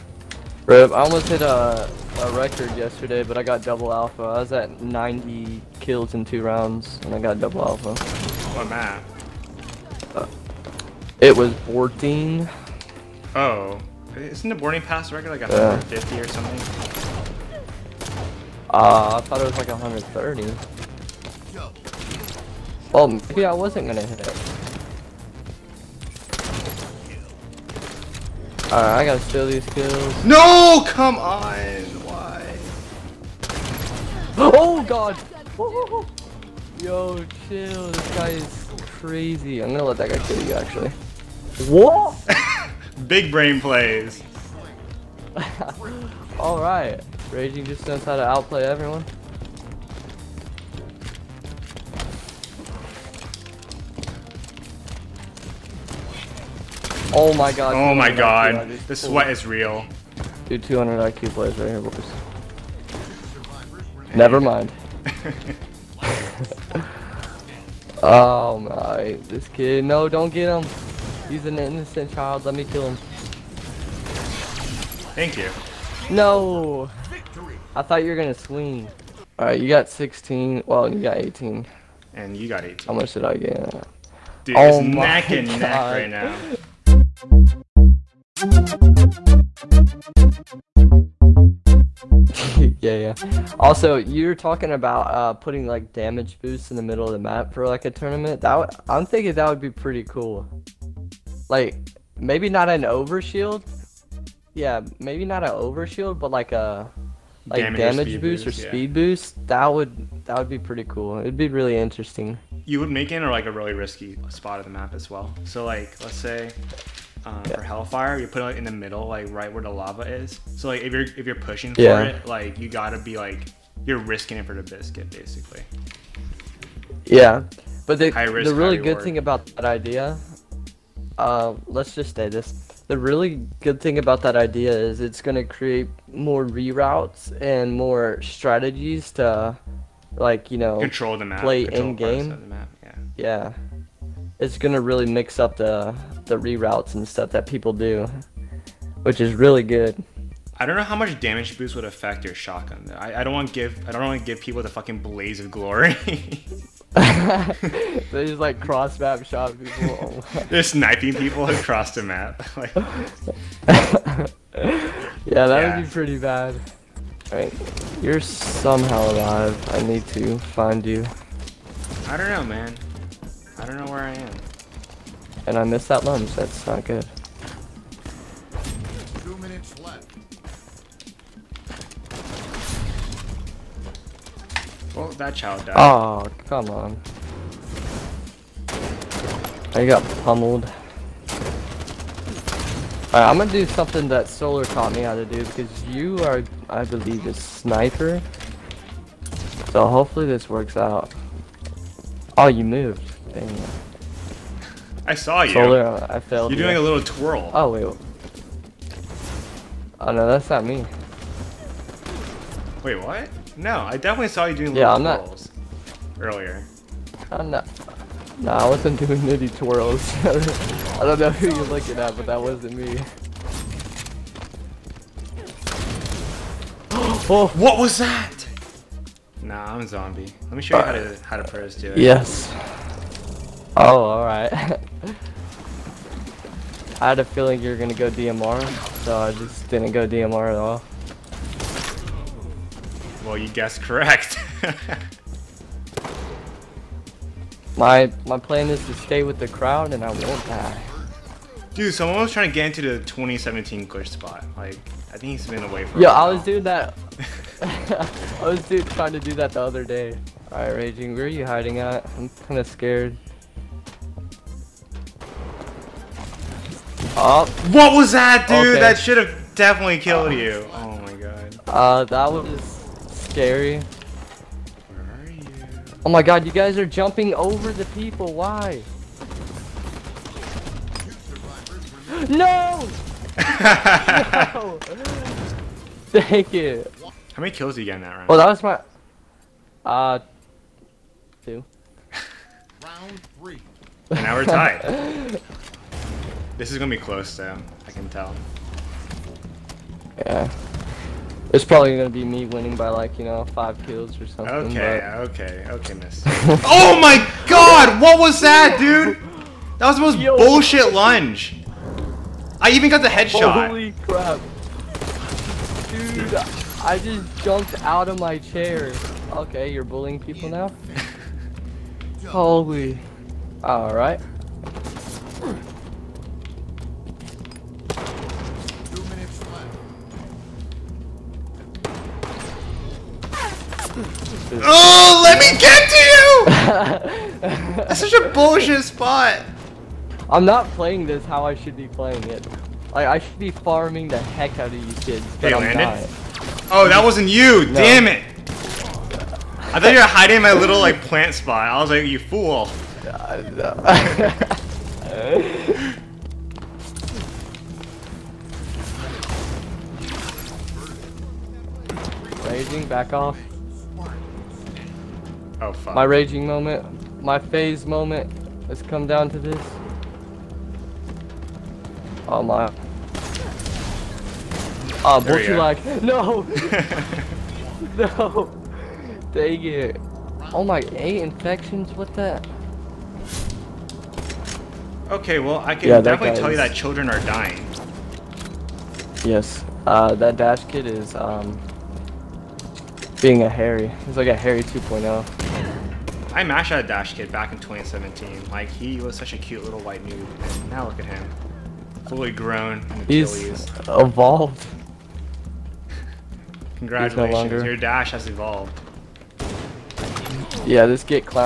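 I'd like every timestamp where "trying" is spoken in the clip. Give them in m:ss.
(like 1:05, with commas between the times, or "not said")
4:12, 4:18.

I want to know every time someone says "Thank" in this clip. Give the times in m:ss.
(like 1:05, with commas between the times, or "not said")
1:15, 4:46.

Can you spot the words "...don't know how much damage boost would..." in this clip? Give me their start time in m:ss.
2:30.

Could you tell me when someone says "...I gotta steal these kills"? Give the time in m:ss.
0:28.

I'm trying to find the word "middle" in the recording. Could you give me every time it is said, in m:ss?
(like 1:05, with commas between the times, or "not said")
1:36, 1:58.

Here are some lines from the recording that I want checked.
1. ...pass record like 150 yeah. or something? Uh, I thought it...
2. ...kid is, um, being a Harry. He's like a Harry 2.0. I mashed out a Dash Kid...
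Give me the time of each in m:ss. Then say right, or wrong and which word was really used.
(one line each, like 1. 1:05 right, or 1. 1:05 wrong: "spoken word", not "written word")
1. 0:14 right
2. 6:30 right.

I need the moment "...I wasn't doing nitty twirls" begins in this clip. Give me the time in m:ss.
3:38.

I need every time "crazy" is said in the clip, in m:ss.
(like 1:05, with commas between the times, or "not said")
0:38.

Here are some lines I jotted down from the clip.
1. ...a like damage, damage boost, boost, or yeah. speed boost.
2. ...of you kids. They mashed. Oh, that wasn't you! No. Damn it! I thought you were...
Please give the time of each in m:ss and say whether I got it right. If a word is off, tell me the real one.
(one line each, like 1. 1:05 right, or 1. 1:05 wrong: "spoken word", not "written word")
1. 1:46 right
2. 5:44 wrong: "landed", not "mashed".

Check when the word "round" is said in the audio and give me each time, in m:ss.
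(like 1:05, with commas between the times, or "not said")
0:06, 4:48, 4:52.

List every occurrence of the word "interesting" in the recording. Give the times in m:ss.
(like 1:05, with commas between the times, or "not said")
1:51.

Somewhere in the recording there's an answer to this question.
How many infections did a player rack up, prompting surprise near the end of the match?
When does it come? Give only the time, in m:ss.
6:20.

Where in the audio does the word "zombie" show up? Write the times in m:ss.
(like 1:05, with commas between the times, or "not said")
3:49.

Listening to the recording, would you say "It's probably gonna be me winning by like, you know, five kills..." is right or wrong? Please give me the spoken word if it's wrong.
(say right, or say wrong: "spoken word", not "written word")
right.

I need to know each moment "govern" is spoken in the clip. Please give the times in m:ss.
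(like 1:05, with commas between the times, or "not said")
not said.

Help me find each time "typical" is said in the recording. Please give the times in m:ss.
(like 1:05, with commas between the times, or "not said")
not said.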